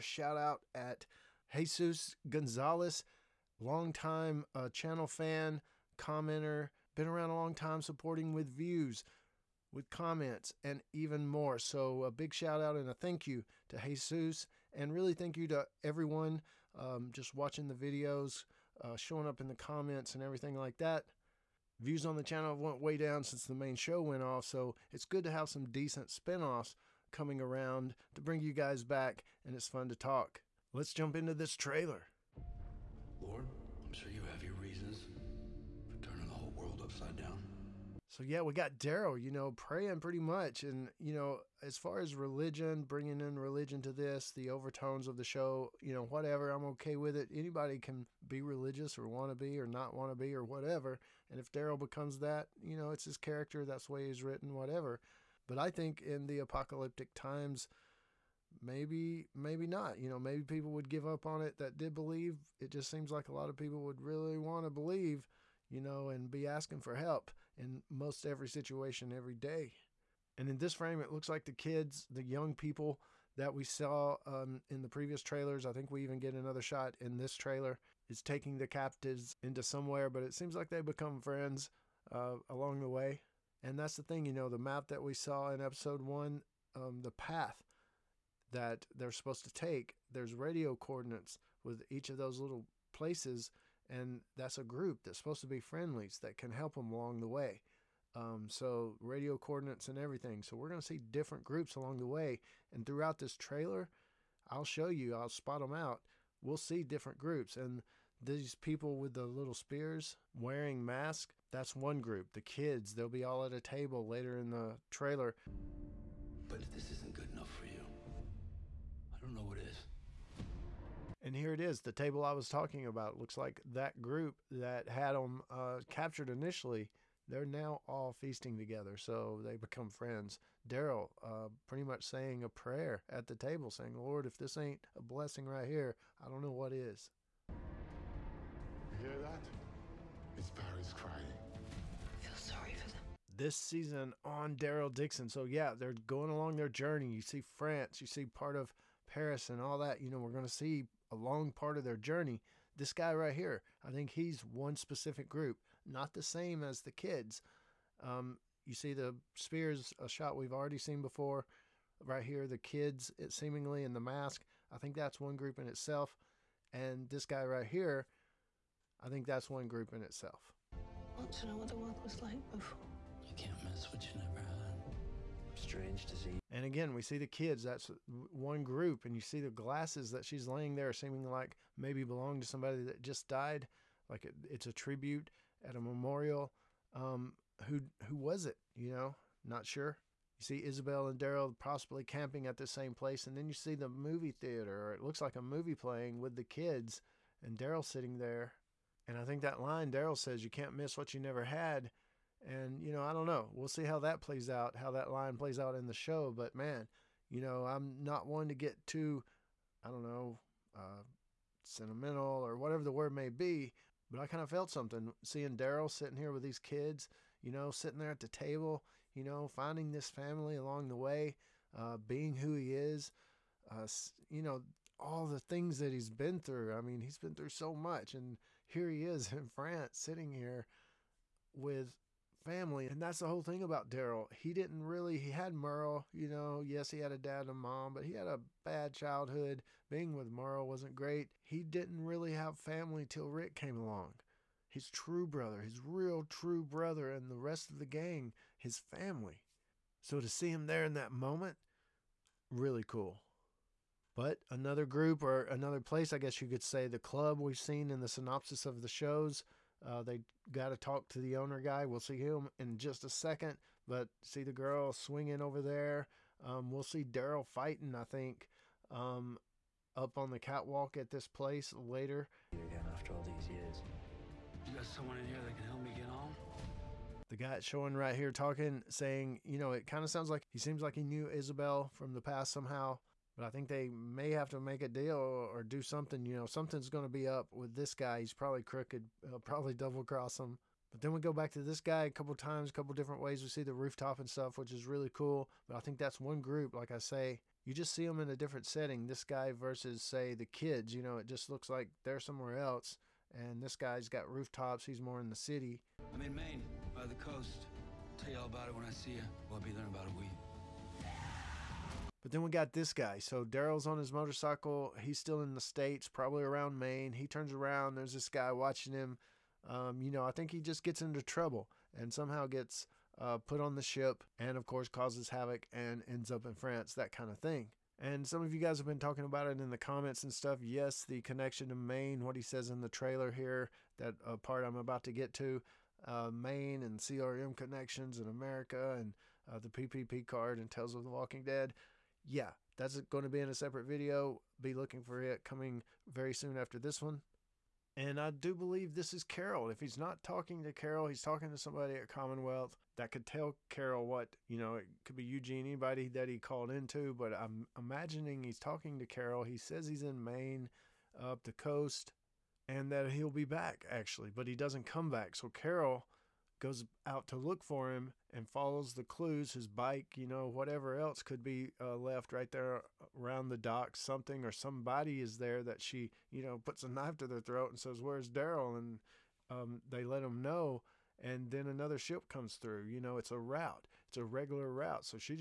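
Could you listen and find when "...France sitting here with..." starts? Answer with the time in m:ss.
3:49.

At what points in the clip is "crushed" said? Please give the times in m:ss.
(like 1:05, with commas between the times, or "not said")
not said.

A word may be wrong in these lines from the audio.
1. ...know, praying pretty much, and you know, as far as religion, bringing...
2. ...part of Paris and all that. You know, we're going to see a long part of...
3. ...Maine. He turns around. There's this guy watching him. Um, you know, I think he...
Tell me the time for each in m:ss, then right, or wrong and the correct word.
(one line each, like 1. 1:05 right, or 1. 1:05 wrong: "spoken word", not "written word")
1. 0:39 right
2. 2:28 right
3. 5:16 right.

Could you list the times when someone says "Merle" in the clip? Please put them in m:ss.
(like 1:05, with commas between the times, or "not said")
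3:55, 4:00.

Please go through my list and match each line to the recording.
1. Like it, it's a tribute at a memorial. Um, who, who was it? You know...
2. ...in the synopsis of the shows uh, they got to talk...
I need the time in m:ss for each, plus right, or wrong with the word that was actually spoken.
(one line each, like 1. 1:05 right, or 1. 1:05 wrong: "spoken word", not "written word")
1. 3:04 right
2. 4:17 right.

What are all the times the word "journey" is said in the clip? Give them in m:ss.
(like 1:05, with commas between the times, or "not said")
2:26, 2:31.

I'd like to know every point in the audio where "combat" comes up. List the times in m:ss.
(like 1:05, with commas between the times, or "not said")
not said.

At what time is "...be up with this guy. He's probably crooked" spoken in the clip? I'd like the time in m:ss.
4:47.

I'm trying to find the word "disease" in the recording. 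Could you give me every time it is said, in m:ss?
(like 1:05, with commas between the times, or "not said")
2:56.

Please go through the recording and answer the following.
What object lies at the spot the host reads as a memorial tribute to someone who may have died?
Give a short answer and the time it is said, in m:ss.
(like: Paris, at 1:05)
Glasses, at 2:59.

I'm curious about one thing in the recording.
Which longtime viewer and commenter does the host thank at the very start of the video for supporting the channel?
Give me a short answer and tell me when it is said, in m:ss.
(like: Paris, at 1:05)
Jesus Gonzalez, at 0:01.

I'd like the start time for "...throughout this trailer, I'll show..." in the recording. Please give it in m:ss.
1:42.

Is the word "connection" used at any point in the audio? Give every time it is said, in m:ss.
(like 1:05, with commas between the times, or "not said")
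5:31, 5:37.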